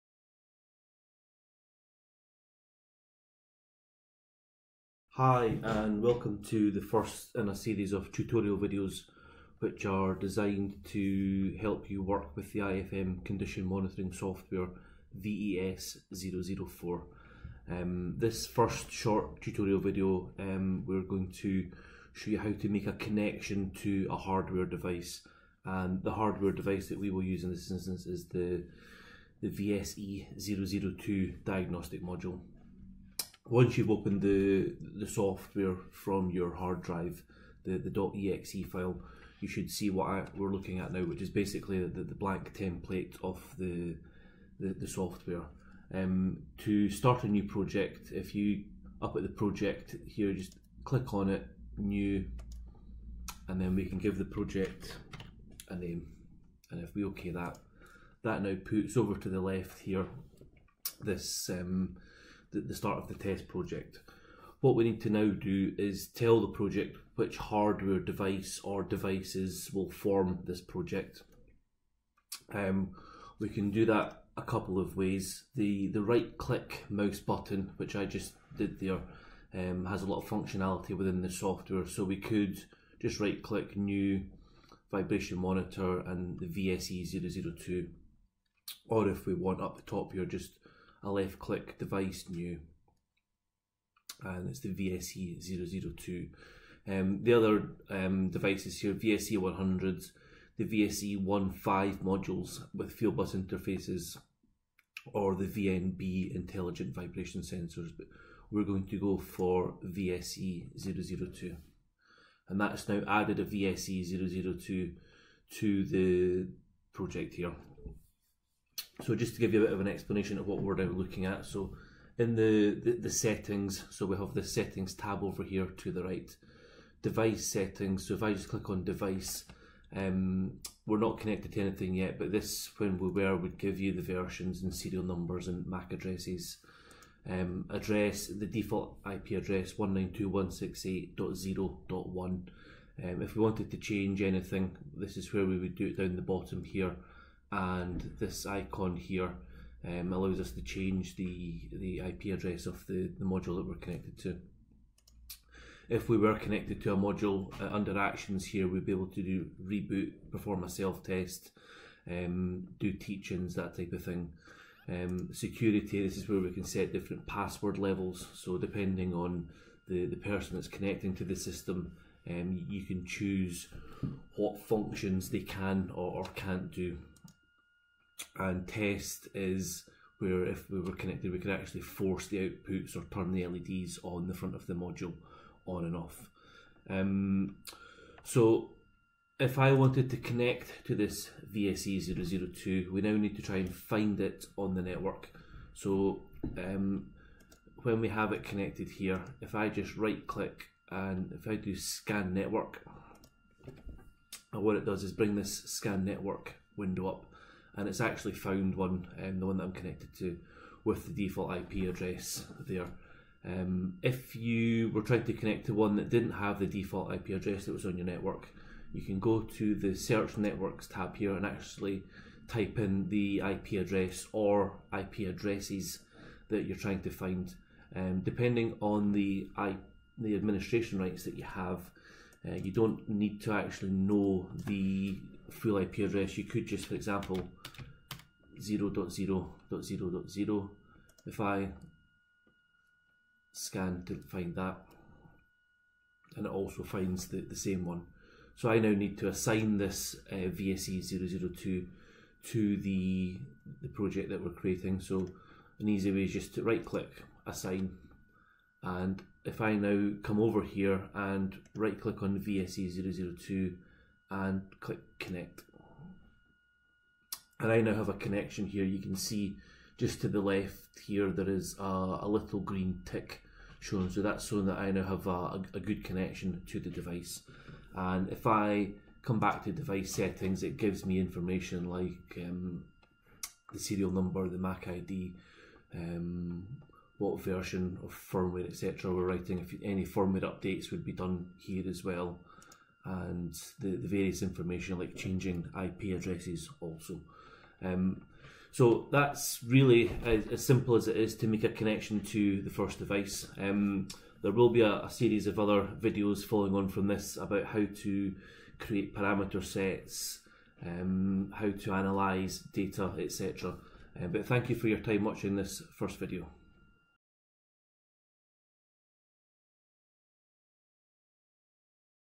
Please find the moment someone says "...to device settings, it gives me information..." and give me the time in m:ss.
4:39.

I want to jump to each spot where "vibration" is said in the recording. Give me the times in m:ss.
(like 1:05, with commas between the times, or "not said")
1:24, 1:46.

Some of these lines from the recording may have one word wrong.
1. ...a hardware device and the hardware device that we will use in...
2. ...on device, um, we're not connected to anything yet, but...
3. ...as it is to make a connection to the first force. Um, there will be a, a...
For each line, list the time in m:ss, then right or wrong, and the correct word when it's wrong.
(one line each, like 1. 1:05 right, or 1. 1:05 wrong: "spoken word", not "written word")
1. 0:24 right
2. 2:08 right
3. 5:00 wrong: "device", not "force".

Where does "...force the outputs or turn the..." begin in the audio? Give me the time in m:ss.
3:01.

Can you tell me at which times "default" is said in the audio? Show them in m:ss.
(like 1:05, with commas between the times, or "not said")
2:18, 3:31, 3:36.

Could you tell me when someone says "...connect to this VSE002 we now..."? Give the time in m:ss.
3:10.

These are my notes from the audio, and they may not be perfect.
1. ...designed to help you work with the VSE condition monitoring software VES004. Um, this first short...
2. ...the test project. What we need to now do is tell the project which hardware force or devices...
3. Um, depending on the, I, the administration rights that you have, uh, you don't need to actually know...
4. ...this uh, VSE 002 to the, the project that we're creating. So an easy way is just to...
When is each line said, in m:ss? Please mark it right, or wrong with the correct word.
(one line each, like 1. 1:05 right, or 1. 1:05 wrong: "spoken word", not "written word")
1. 0:10 wrong: "IFM", not "VSE"
2. 1:03 wrong: "device", not "force"
3. 3:47 right
4. 4:09 right.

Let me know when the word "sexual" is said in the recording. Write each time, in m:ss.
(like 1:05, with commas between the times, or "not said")
not said.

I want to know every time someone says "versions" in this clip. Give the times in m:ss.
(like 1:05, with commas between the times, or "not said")
2:14, 4:47.